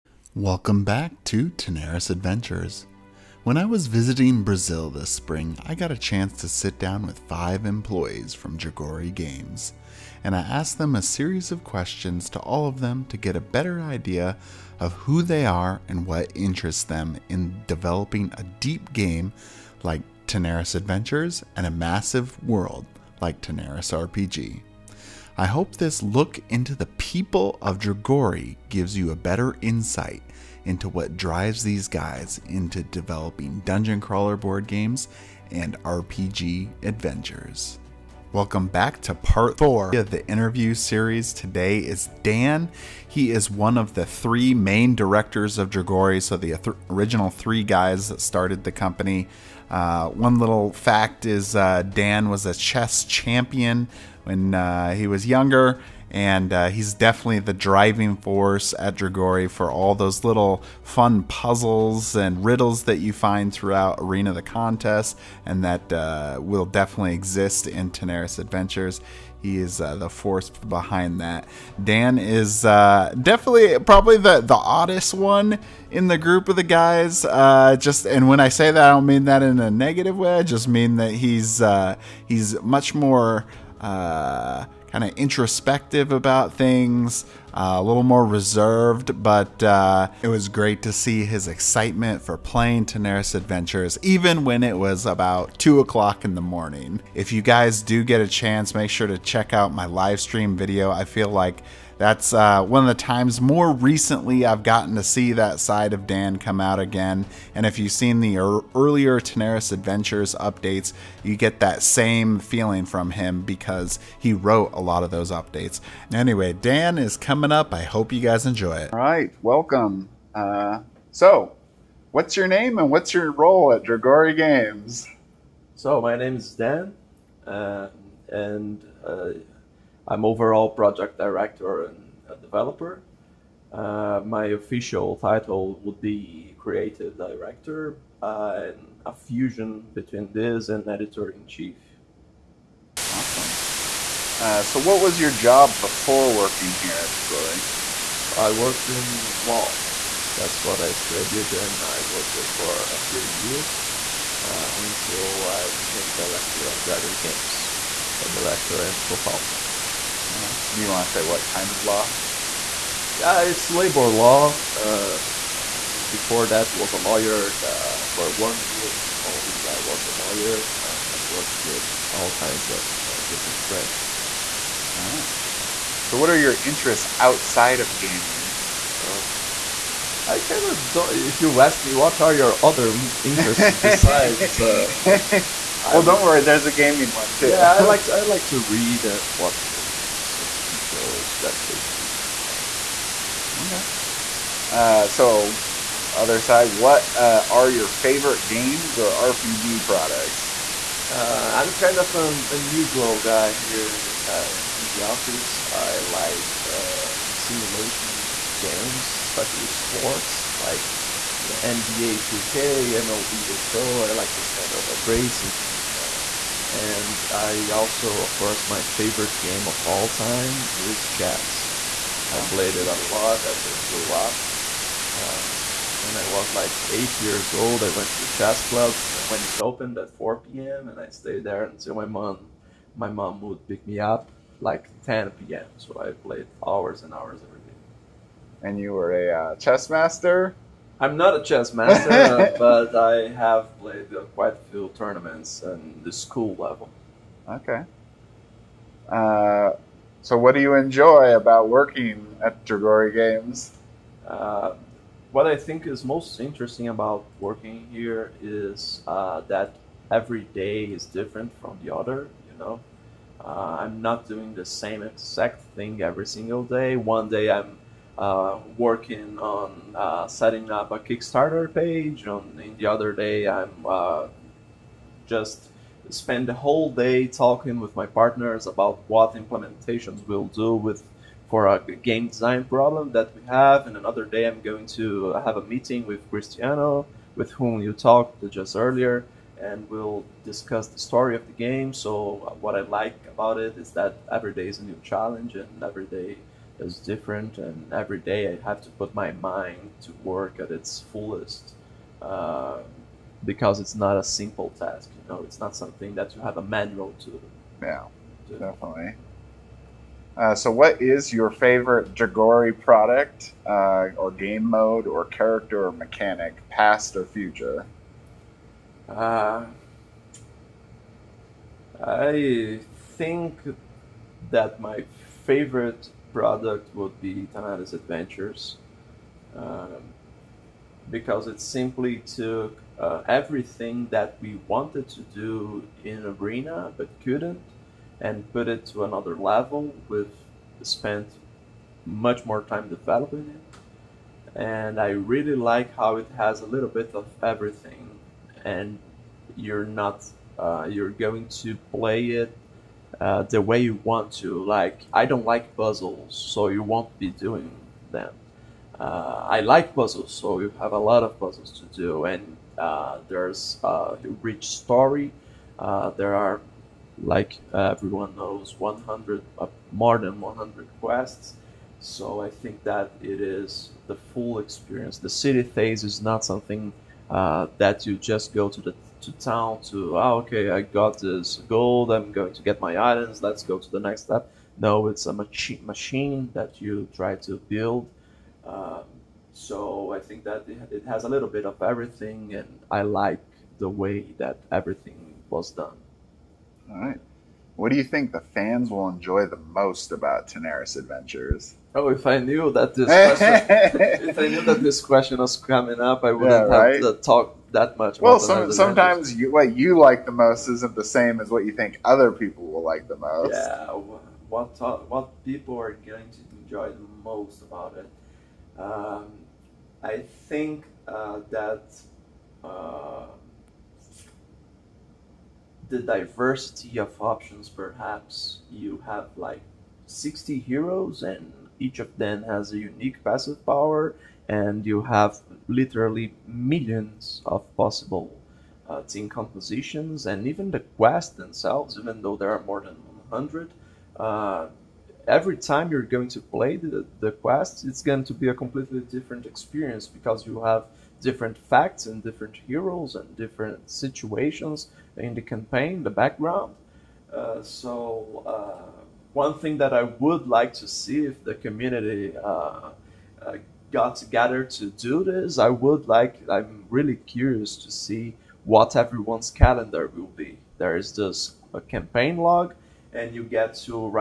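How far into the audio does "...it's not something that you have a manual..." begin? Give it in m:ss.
5:05.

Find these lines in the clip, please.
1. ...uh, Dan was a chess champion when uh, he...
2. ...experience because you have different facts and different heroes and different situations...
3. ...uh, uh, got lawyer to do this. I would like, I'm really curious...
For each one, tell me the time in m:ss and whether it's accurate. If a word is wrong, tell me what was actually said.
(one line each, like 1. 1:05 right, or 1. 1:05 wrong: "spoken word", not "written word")
1. 0:51 right
2. 7:29 right
3. 7:42 wrong: "together", not "lawyer".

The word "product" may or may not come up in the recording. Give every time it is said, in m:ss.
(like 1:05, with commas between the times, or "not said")
3:19, 5:12, 5:26.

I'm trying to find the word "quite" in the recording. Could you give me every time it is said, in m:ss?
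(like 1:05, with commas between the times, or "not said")
4:04.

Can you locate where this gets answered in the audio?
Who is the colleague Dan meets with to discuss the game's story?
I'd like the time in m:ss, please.
4:46.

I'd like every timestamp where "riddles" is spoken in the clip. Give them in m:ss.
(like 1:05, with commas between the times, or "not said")
1:02.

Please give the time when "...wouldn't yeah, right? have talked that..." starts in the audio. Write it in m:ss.
6:46.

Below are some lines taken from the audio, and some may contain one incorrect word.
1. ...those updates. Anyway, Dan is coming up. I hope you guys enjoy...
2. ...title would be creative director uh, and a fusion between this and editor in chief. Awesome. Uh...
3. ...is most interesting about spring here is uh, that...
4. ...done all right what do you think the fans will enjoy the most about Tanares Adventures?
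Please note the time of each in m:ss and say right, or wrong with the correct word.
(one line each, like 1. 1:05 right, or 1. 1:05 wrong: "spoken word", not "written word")
1. 1:55 right
2. 2:15 right
3. 4:15 wrong: "working", not "spring"
4. 6:35 right.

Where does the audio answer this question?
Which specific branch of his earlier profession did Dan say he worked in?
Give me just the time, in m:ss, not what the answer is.
2:43.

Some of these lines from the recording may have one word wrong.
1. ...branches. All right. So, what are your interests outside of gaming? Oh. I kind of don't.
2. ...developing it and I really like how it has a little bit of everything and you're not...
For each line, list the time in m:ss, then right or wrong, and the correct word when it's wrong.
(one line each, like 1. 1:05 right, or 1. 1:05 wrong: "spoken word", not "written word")
1. 2:53 right
2. 5:42 right.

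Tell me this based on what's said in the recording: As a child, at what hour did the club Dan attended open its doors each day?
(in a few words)
4 p.m.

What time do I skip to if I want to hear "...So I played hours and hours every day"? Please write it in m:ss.
3:55.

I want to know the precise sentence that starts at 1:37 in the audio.
If you guys do get a chance, make sure to check out my live stream video.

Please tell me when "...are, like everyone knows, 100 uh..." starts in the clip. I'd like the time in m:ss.
6:06.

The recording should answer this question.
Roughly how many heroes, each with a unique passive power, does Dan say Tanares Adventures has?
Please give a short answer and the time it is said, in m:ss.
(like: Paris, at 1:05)
60, at 7:10.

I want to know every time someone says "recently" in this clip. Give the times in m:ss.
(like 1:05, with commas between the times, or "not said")
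1:43.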